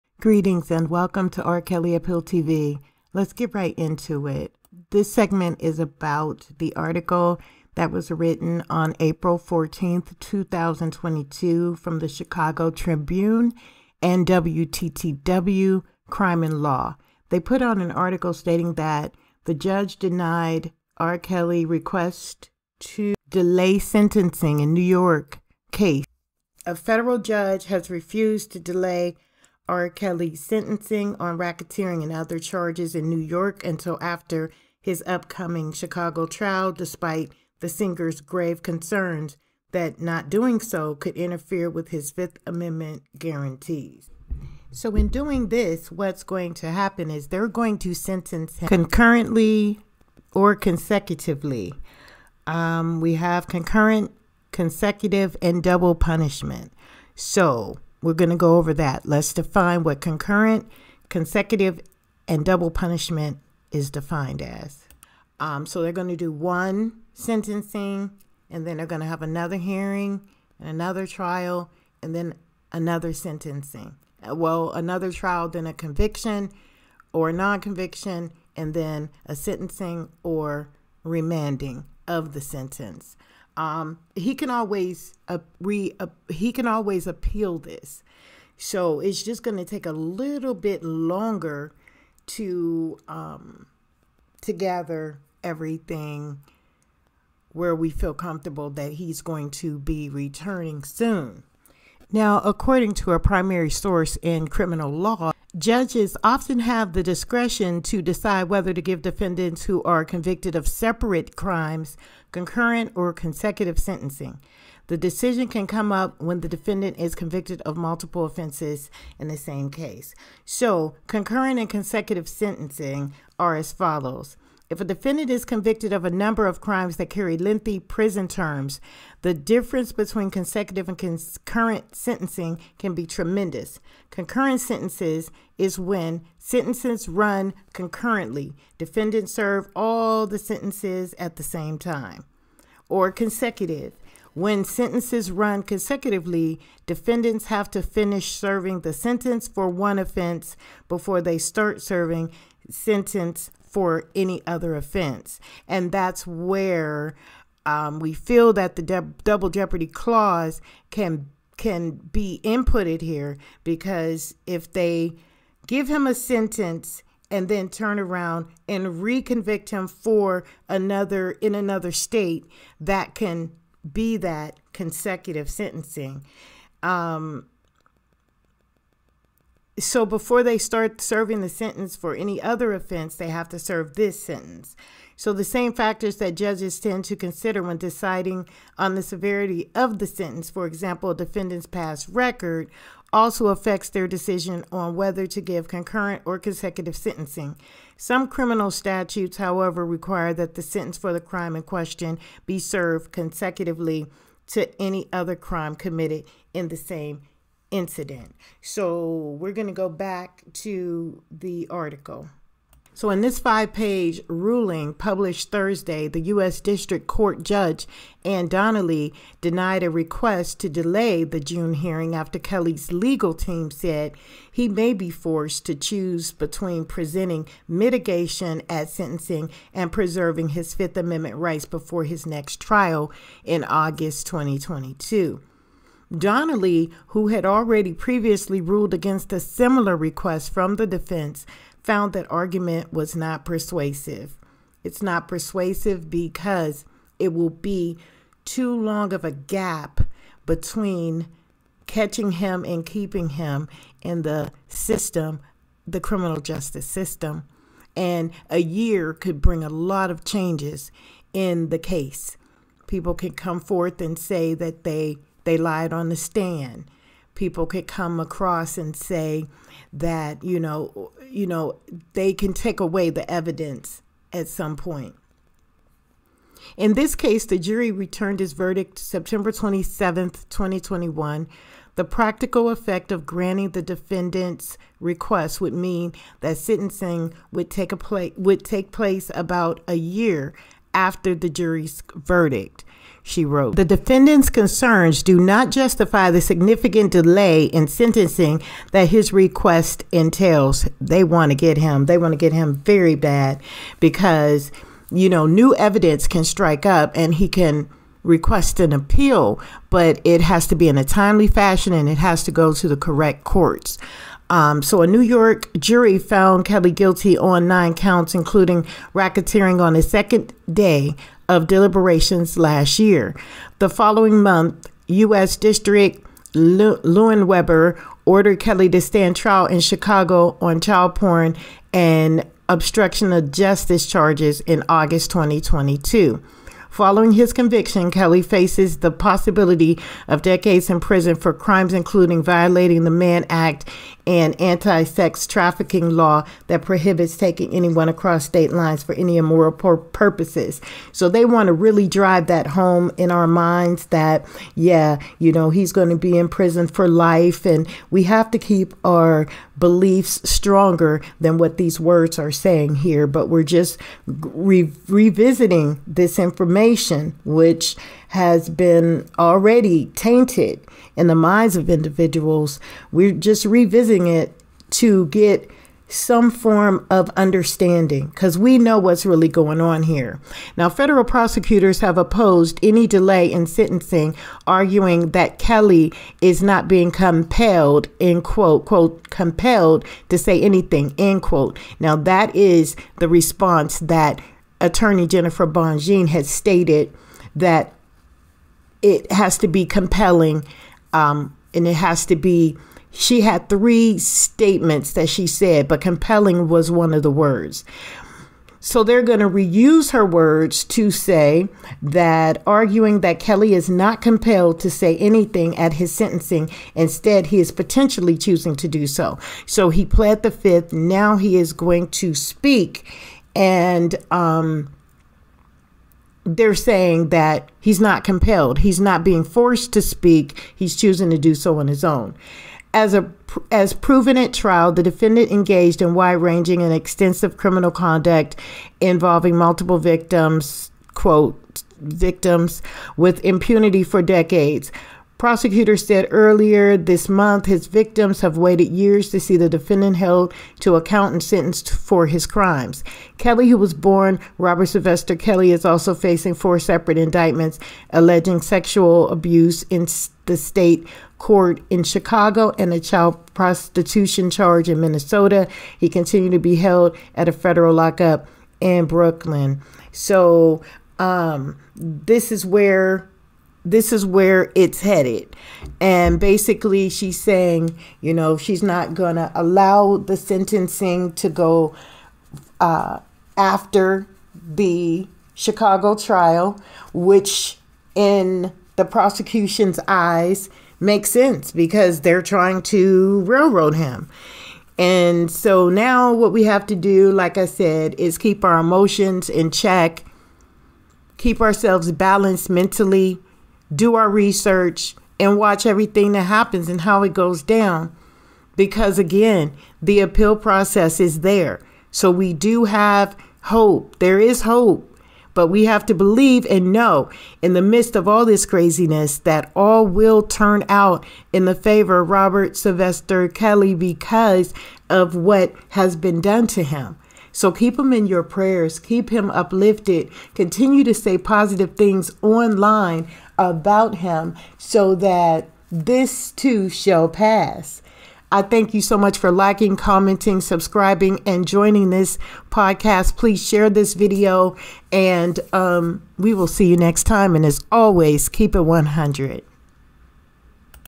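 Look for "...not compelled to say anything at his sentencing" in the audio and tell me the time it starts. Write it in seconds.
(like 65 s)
413 s.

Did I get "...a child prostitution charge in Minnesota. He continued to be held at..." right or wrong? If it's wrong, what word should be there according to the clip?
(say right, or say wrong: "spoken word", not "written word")
right.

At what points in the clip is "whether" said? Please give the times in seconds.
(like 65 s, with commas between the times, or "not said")
108 s, 194 s.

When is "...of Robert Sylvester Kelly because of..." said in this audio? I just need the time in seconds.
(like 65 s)
522 s.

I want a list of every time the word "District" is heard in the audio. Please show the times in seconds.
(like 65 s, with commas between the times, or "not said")
216 s, 325 s.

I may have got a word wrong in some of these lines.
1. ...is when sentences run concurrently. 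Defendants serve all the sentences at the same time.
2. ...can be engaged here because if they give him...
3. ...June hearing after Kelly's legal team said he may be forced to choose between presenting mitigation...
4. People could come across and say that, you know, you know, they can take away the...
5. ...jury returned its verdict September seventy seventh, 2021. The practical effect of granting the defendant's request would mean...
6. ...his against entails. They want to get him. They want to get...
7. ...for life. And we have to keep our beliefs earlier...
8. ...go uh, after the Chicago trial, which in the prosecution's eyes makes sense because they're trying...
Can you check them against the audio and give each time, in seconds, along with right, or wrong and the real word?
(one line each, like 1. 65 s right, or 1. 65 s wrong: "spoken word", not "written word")
1. 135 s right
2. 161 s wrong: "inputted", not "engaged"
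3. 221 s right
4. 267 s right
5. 277 s wrong: "twenty", not "seventy"
6. 299 s wrong: "request", not "against"
7. 356 s wrong: "stronger", not "earlier"
8. 481 s right.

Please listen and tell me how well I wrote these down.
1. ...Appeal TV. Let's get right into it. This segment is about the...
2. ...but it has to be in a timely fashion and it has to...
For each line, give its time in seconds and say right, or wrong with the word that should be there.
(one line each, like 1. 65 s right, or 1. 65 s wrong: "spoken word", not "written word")
1. 1 s right
2. 309 s right.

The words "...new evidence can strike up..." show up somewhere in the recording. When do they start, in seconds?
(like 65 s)
305 s.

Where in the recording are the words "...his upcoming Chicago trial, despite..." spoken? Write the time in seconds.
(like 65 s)
34 s.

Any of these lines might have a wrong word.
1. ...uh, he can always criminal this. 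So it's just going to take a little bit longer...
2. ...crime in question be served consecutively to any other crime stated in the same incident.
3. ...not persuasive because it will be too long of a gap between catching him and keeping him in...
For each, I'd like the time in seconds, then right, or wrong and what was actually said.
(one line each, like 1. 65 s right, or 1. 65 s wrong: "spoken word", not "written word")
1. 85 s wrong: "appeal", not "criminal"
2. 201 s wrong: "committed", not "stated"
3. 245 s right.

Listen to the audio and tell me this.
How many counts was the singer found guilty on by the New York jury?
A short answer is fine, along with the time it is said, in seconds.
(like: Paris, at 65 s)
9, at 317 s.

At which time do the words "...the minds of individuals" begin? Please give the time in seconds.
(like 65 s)
371 s.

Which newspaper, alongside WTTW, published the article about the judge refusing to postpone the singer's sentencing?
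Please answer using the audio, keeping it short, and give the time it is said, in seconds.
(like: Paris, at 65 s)
Chicago Tribune, at 12 s.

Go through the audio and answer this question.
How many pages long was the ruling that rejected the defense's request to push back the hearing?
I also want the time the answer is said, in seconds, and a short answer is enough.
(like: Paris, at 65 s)
5, at 213 s.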